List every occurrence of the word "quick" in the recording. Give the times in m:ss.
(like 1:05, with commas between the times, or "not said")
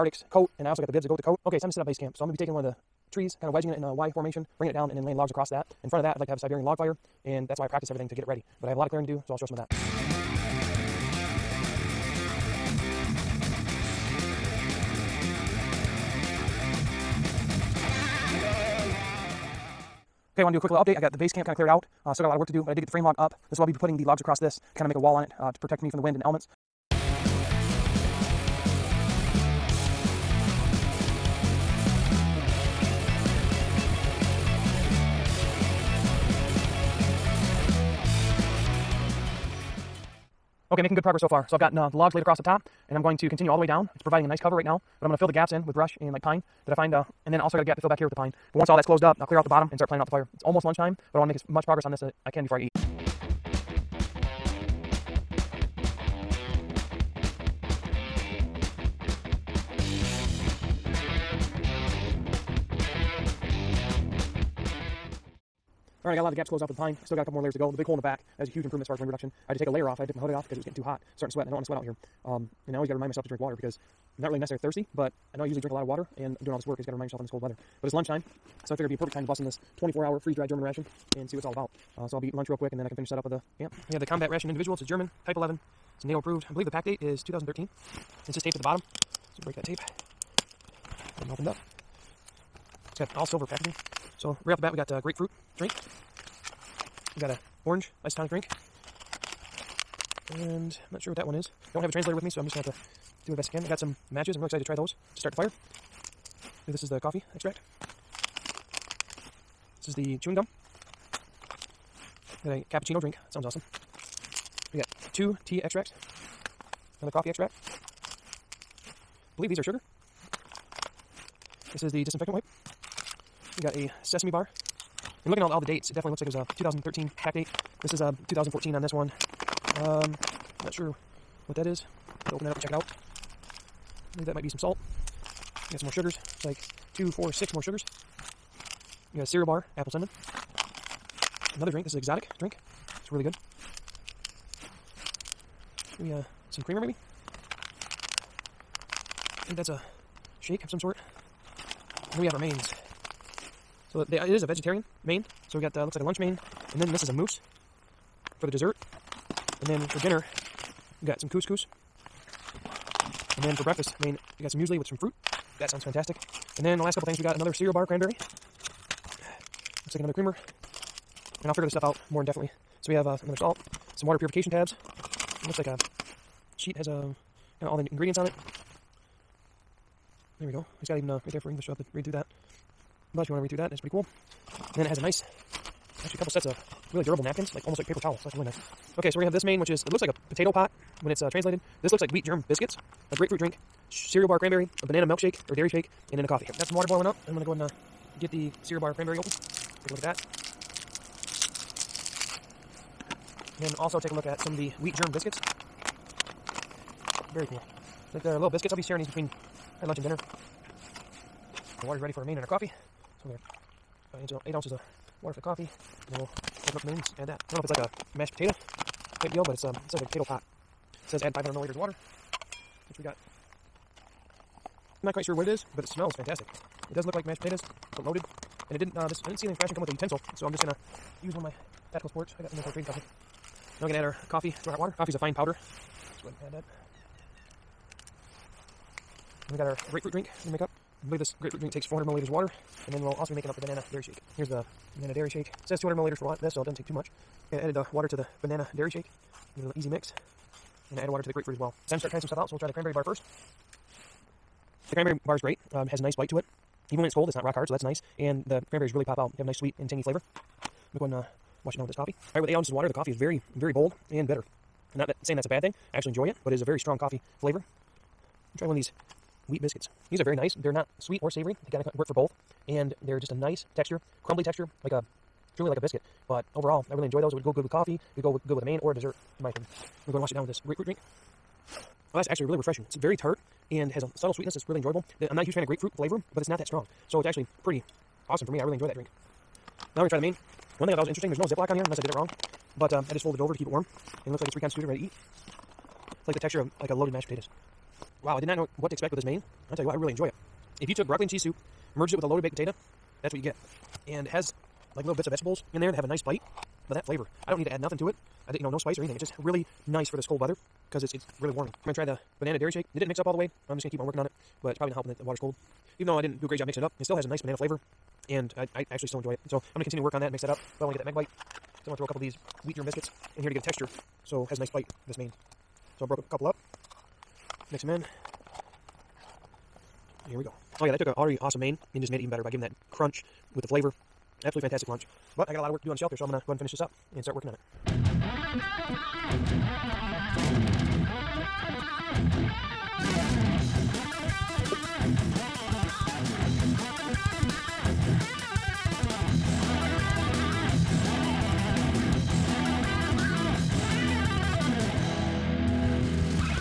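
0:20, 1:22.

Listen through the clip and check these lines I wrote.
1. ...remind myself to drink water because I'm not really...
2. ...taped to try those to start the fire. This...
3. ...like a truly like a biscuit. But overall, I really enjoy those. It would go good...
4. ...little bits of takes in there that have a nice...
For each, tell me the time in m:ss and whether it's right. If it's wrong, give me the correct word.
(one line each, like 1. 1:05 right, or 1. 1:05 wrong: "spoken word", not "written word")
1. 1:12 right
2. 1:44 wrong: "excited", not "taped"
3. 4:34 right
4. 5:05 wrong: "vegetables", not "takes".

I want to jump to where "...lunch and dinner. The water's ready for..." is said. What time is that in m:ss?
3:29.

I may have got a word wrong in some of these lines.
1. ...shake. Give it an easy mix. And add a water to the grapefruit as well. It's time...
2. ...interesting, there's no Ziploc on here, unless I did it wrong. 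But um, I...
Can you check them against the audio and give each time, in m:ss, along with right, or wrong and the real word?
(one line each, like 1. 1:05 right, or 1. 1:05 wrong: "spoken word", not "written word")
1. 4:08 right
2. 4:51 right.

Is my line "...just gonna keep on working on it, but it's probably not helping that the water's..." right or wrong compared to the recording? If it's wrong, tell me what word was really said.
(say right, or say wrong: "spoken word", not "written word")
right.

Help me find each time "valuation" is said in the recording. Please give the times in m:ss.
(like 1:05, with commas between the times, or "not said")
not said.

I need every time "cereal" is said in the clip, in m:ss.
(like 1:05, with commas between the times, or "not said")
2:19, 2:47, 3:13, 3:18.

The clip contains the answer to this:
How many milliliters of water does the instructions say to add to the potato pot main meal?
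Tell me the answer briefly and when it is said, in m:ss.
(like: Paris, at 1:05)
500, at 3:41.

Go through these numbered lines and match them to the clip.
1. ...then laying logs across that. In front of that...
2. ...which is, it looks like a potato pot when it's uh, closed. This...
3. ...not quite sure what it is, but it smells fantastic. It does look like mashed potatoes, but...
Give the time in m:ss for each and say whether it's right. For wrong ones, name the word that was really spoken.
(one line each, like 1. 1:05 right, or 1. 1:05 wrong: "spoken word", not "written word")
1. 0:04 right
2. 3:09 wrong: "translated", not "closed"
3. 3:45 right.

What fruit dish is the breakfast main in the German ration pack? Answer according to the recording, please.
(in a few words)
Muesli.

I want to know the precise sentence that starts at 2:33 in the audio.
So uh, they, uh, it is a vegetarian main.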